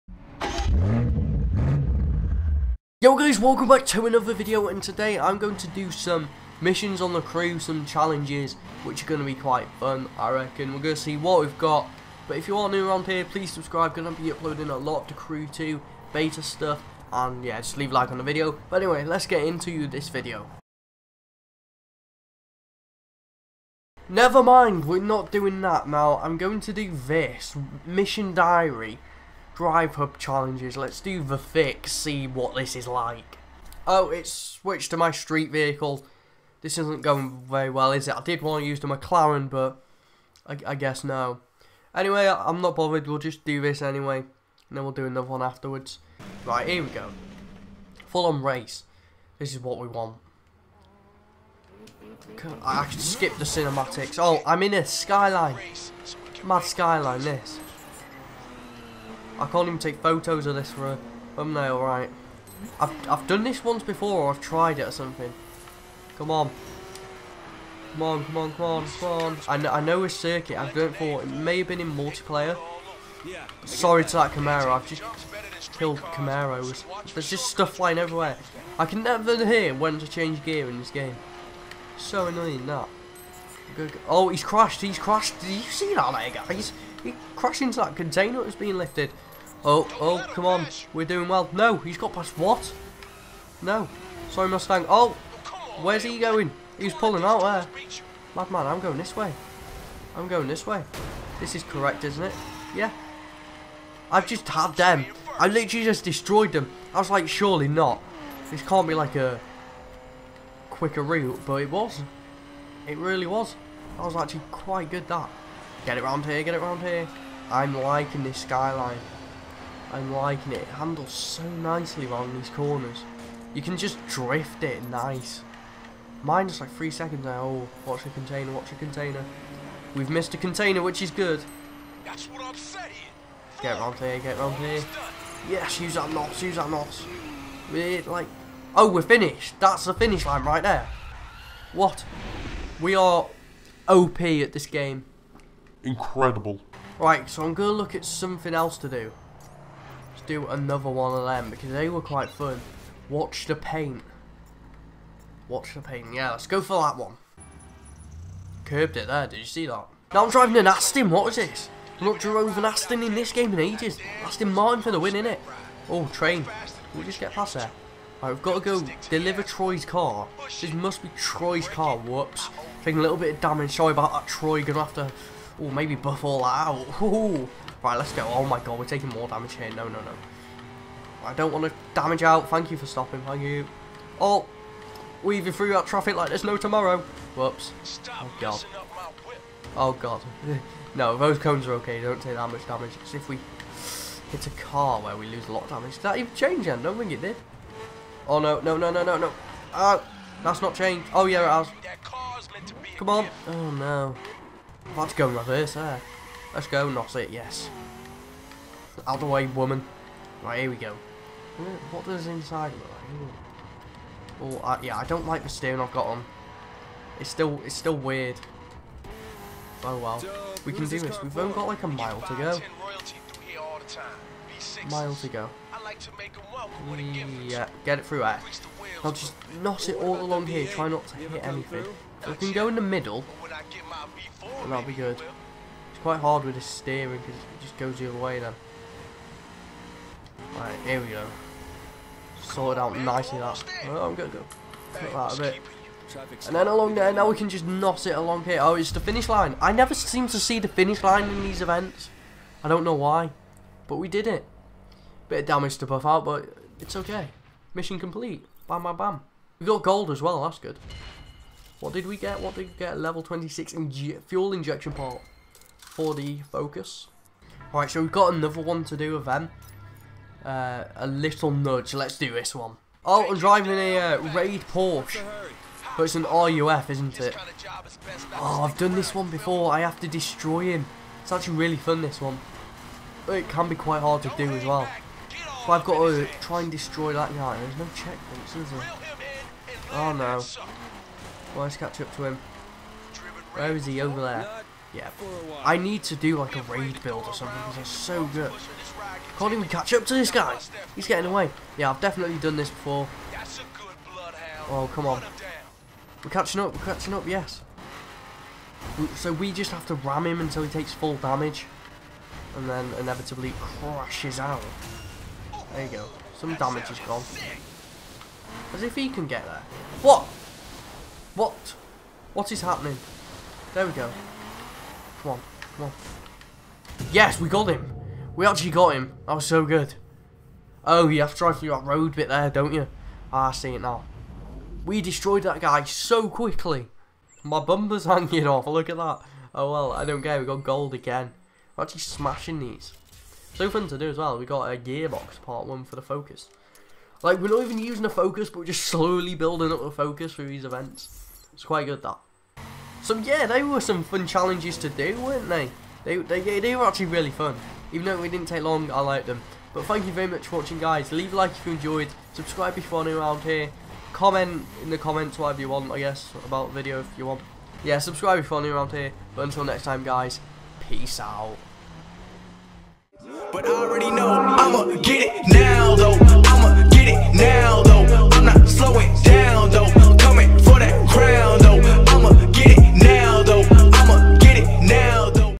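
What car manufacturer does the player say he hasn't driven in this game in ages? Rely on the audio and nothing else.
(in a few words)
Aston Martin.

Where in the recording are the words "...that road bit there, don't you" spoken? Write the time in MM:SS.
05:31.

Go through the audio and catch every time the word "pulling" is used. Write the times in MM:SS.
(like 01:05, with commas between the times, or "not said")
01:36.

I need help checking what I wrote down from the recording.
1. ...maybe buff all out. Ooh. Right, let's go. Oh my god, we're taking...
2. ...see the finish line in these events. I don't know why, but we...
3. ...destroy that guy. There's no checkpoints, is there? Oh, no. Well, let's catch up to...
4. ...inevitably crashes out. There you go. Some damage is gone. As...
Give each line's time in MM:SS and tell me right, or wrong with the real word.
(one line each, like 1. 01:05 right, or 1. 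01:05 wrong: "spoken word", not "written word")
1. 02:55 right
2. 04:10 right
3. 04:46 right
4. 05:12 right.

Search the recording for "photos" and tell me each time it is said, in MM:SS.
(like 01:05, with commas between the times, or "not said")
00:59.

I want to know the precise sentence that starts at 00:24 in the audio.
Never mind, we're not doing that now, I'm going to do this, Mission Diary drive hub challenges.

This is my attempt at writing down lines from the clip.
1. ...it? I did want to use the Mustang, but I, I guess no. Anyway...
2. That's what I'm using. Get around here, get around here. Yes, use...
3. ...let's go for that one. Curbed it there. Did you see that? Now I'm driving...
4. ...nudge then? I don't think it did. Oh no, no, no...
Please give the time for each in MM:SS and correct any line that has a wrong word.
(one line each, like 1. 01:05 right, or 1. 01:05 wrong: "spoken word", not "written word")
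1. 00:38 wrong: "McLaren", not "Mustang"
2. 02:12 wrong: "saying", not "using"
3. 02:36 right
4. 03:16 wrong: "change", not "nudge".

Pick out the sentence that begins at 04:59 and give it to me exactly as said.
Can't even catch up to this guy.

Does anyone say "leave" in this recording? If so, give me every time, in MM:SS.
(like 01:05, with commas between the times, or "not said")
00:17, 06:01.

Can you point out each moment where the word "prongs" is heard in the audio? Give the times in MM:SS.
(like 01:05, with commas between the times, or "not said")
not said.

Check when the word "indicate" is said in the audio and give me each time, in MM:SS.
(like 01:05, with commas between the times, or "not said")
not said.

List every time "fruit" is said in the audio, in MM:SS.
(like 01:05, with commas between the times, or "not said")
not said.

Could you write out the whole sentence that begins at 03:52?
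So we can go in the middle, and that'll be good.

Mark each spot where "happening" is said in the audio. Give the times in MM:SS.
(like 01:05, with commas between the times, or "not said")
05:22.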